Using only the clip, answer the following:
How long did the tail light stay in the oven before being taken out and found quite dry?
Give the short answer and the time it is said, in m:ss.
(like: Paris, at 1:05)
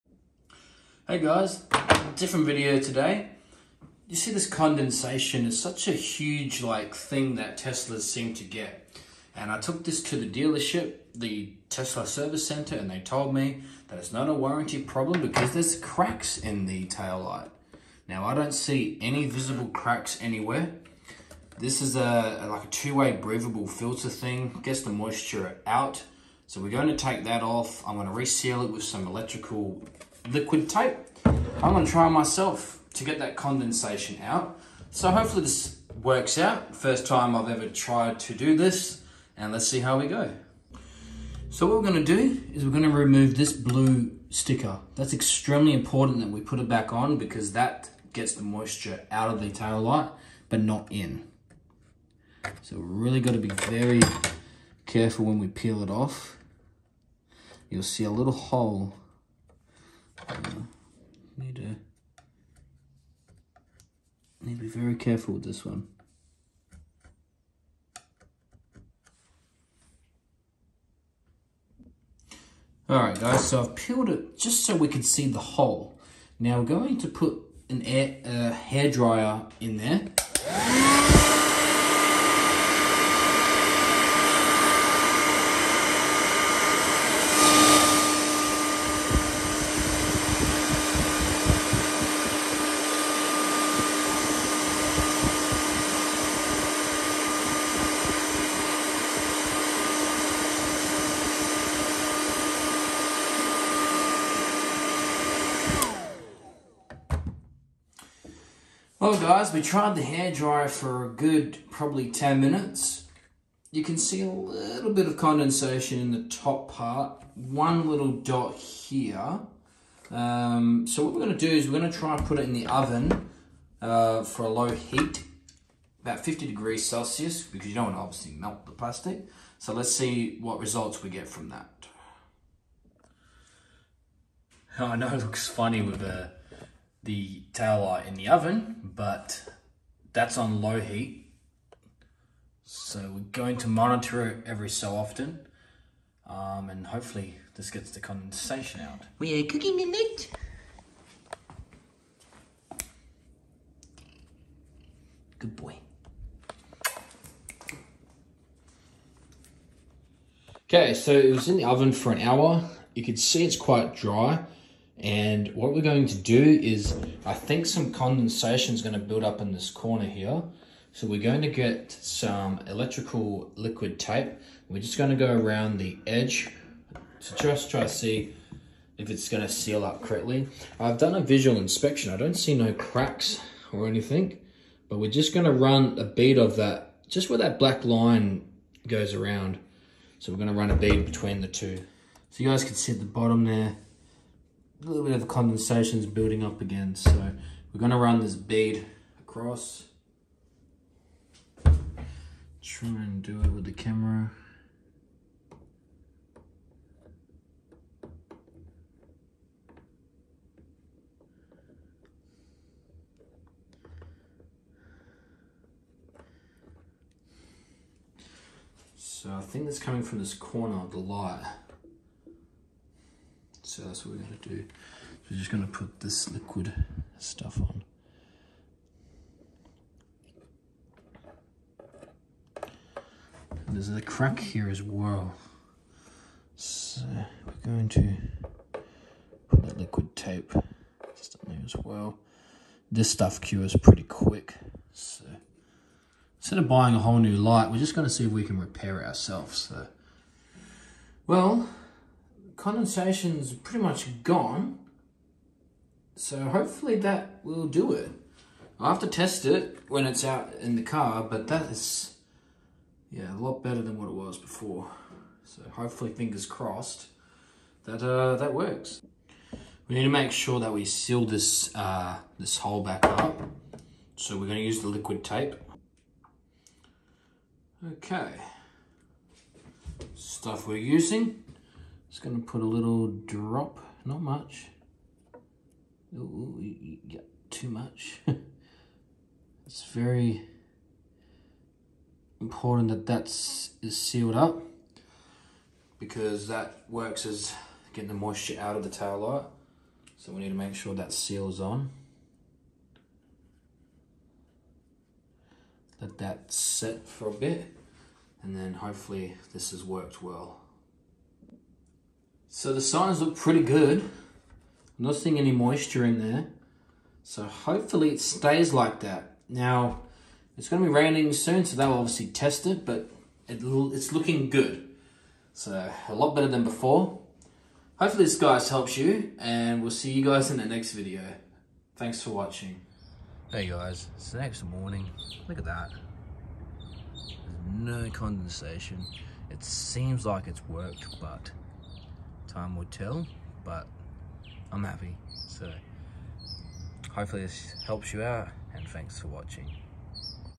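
An hour, at 2:42.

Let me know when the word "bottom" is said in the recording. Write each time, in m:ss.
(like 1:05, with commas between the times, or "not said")
3:13.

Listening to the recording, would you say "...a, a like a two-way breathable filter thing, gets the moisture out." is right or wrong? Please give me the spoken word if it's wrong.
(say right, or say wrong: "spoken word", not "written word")
right.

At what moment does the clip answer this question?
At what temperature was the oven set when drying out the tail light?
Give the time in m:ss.
2:06.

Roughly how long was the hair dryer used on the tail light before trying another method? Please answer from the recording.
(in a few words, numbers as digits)
10 minutes.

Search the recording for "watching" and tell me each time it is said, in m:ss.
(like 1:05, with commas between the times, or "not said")
5:32, 5:49.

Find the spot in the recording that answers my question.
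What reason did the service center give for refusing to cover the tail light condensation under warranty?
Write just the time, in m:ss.
0:15.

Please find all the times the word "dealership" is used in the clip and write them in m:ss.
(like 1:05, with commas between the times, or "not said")
0:10.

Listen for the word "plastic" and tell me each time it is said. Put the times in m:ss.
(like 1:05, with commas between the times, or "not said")
2:08.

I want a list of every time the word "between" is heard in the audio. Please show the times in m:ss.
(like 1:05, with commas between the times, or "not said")
3:11.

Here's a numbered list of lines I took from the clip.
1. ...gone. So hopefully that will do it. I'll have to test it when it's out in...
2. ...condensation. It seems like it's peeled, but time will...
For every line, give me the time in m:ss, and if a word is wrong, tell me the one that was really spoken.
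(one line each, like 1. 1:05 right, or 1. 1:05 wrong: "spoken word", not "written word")
1. 4:14 right
2. 5:38 wrong: "worked", not "peeled".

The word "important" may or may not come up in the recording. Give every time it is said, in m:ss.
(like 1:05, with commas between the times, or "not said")
0:45, 4:52.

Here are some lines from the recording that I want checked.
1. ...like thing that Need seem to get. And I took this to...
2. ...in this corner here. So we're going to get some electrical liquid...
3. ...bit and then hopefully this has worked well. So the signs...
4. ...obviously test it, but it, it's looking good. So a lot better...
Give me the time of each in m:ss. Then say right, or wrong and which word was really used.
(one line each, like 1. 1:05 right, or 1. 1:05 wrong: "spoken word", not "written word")
1. 0:06 wrong: "Teslas", not "Need"
2. 2:49 right
3. 5:07 right
4. 5:21 right.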